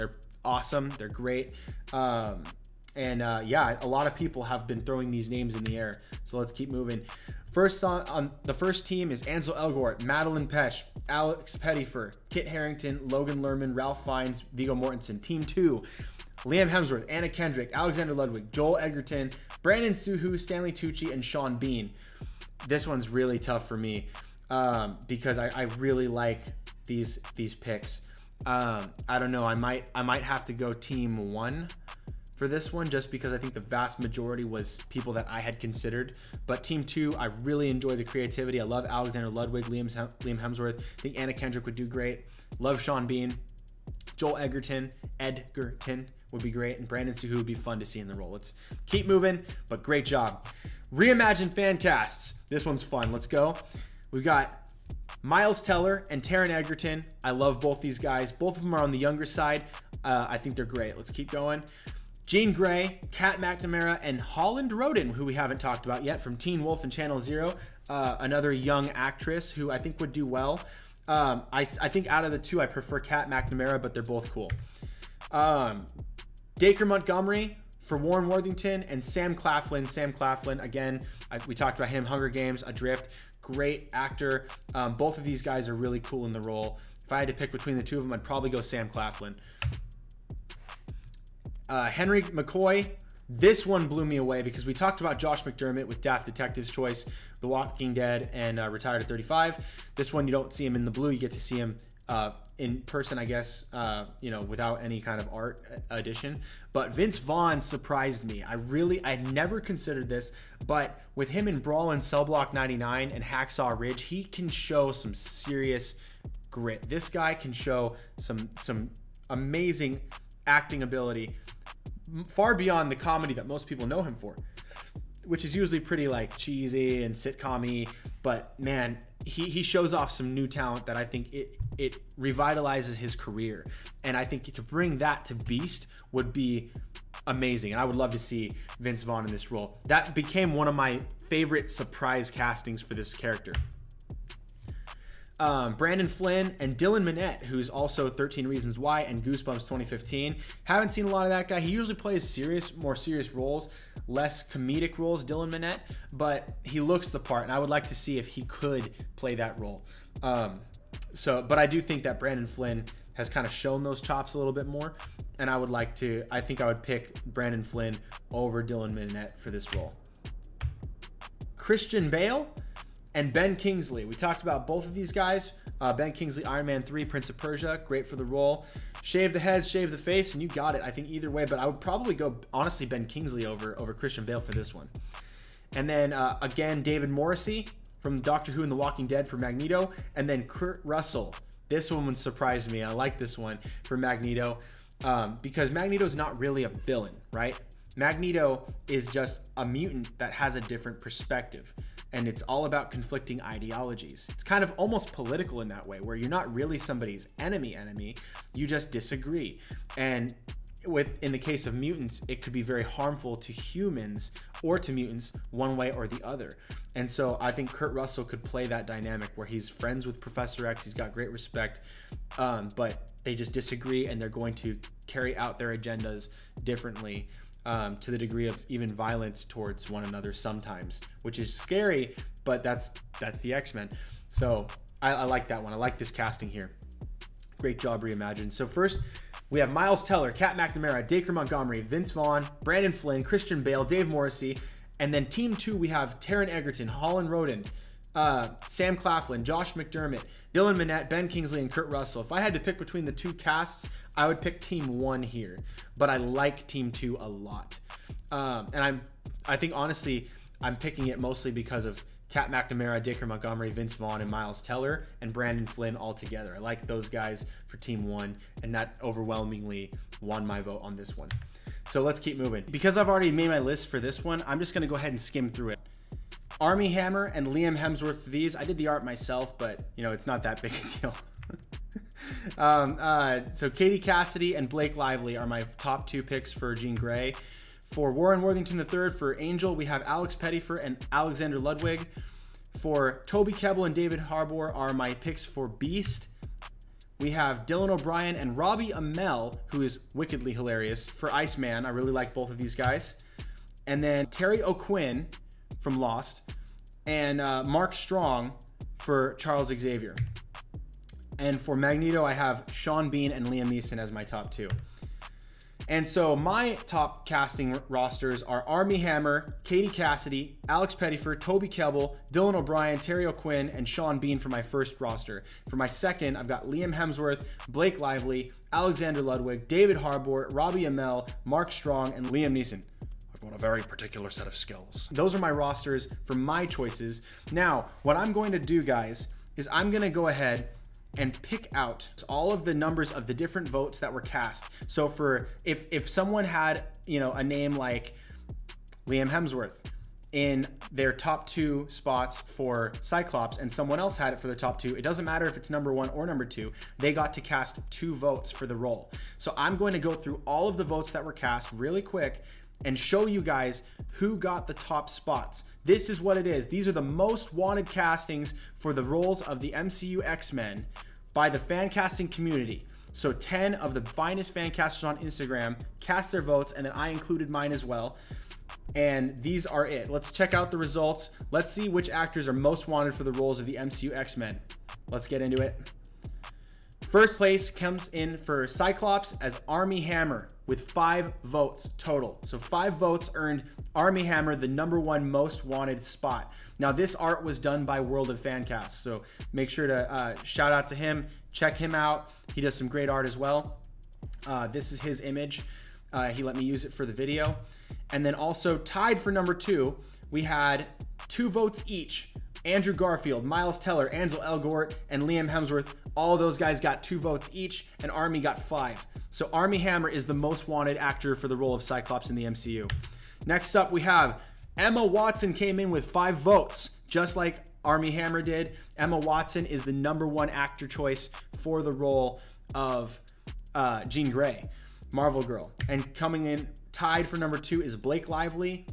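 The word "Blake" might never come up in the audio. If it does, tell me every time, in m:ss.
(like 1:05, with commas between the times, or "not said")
4:44, 5:27, 7:17.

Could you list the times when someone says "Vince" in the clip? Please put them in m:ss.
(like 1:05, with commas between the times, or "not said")
1:46, 2:18, 4:01, 4:23.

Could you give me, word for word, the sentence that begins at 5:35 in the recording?
Those are my rosters for my choices.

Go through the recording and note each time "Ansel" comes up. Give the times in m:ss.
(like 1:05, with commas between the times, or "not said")
0:09, 6:54.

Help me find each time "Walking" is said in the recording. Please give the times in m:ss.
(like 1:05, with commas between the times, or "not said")
1:37, 3:08.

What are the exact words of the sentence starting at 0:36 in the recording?
But team two, I really enjoy the creativity.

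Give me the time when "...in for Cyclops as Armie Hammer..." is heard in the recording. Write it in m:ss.
6:28.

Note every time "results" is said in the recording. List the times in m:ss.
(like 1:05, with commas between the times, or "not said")
6:20.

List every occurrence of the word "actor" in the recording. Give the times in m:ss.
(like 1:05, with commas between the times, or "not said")
1:23, 6:22, 7:00, 7:10.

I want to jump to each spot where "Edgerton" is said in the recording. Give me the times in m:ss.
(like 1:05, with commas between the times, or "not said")
0:45.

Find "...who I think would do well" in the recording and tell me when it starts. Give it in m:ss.
1:09.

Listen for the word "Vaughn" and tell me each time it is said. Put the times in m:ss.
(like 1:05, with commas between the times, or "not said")
1:47, 2:19, 4:02, 4:23.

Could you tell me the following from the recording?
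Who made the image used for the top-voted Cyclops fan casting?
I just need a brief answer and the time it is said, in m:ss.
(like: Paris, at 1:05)
World of Fancast, at 6:38.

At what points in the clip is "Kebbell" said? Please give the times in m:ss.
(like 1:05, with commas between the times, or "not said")
4:53, 5:21.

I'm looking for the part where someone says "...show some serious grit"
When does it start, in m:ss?
1:54.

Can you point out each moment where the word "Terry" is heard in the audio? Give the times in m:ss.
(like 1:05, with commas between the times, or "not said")
5:04, 5:22.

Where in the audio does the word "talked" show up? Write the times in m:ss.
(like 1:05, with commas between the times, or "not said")
1:05, 1:21, 1:34, 2:54.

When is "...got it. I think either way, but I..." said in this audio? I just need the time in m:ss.
3:00.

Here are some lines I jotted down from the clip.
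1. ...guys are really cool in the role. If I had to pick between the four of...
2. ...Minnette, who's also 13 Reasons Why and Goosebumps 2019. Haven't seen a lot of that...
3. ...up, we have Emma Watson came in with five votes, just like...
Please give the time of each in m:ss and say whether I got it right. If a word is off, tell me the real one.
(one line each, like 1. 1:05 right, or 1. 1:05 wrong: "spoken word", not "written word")
1. 1:25 wrong: "two", not "four"
2. 2:27 wrong: "2015", not "2019"
3. 7:03 right.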